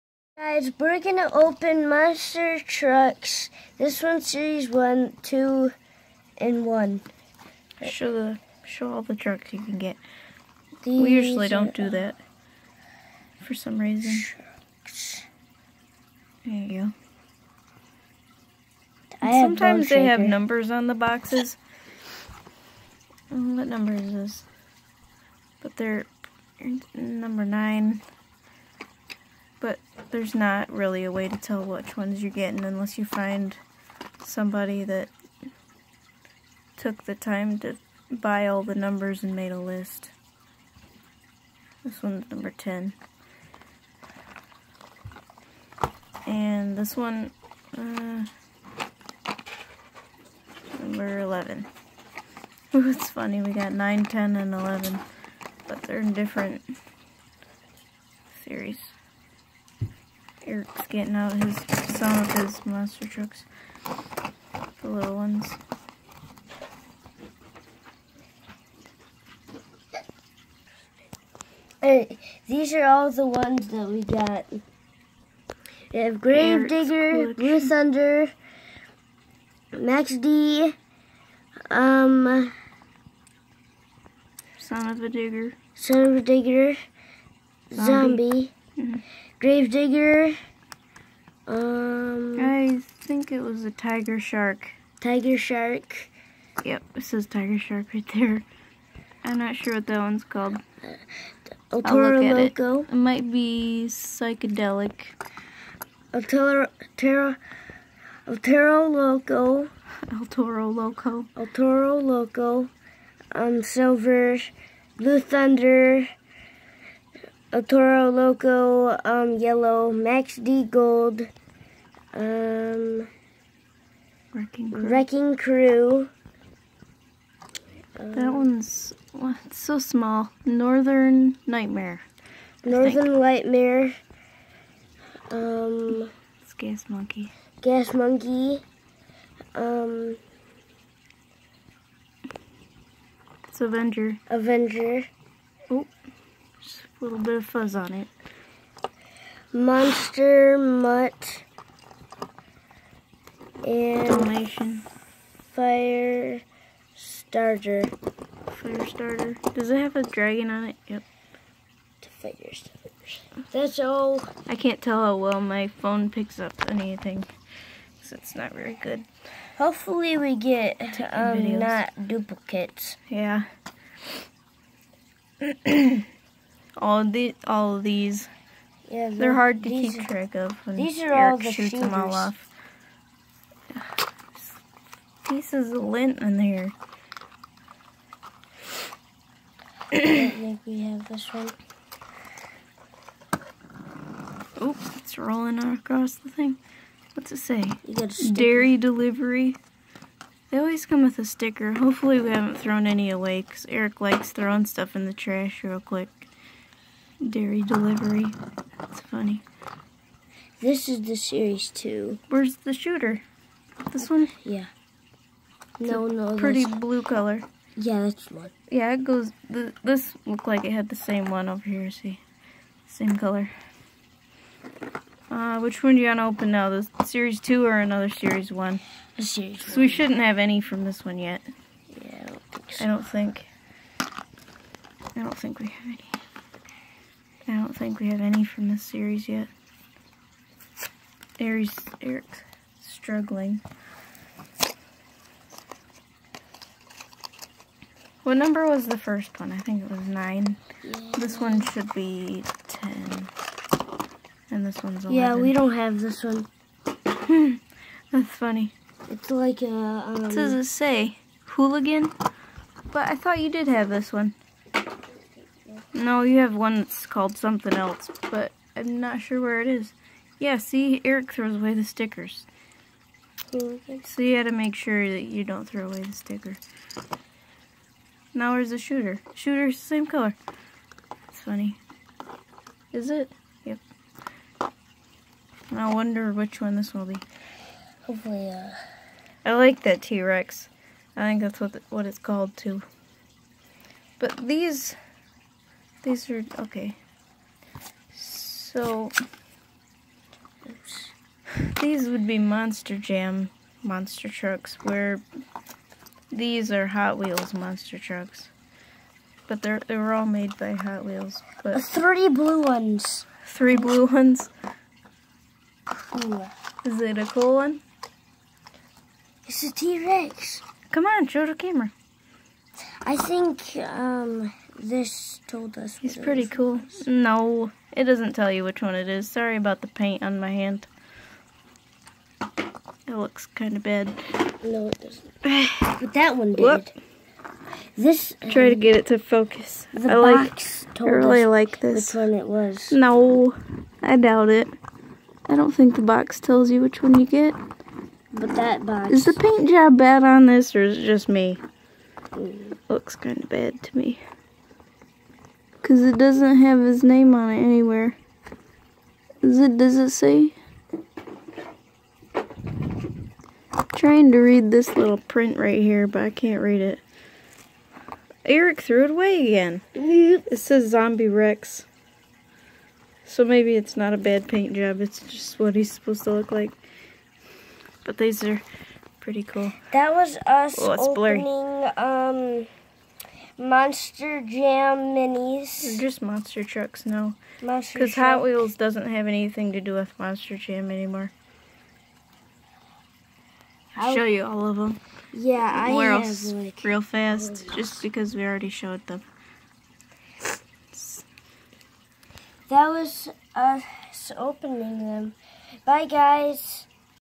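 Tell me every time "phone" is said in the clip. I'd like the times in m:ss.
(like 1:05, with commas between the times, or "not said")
2:45.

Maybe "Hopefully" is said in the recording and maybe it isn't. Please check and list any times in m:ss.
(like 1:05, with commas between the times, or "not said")
2:49, 3:21, 4:48.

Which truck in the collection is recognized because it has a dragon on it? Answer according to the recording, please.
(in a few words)
Fire Starter.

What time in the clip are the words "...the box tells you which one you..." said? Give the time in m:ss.
5:45.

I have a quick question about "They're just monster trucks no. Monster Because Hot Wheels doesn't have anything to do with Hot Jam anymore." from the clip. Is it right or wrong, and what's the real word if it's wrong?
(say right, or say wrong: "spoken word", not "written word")
wrong: "Monster", not "Hot".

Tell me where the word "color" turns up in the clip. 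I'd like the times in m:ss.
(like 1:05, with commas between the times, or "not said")
3:37, 3:43, 4:40.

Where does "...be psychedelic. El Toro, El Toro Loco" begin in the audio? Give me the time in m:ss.
1:43.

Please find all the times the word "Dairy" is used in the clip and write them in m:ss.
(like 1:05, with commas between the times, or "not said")
3:18, 3:27.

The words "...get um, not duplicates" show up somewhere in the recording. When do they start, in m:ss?
2:50.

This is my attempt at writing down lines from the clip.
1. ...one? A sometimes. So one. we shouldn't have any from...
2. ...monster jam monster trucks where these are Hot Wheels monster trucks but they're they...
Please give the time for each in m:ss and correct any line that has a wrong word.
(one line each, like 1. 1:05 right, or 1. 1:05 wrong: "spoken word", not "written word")
1. 3:48 wrong: "series", not "sometimes"
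2. 5:02 right.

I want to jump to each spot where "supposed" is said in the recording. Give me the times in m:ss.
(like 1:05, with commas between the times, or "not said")
6:15.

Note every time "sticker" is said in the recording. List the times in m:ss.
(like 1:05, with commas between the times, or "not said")
3:21, 4:31, 4:36.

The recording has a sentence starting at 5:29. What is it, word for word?
Sorry about the paint on my hand.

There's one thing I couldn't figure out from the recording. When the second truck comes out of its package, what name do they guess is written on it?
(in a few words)
Hooligan.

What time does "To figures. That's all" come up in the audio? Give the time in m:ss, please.
2:42.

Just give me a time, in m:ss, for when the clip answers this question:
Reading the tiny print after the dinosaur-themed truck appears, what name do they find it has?
6:10.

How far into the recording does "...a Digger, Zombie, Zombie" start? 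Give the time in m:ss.
1:26.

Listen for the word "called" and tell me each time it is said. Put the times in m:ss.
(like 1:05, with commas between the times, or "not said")
1:40, 4:27, 4:52.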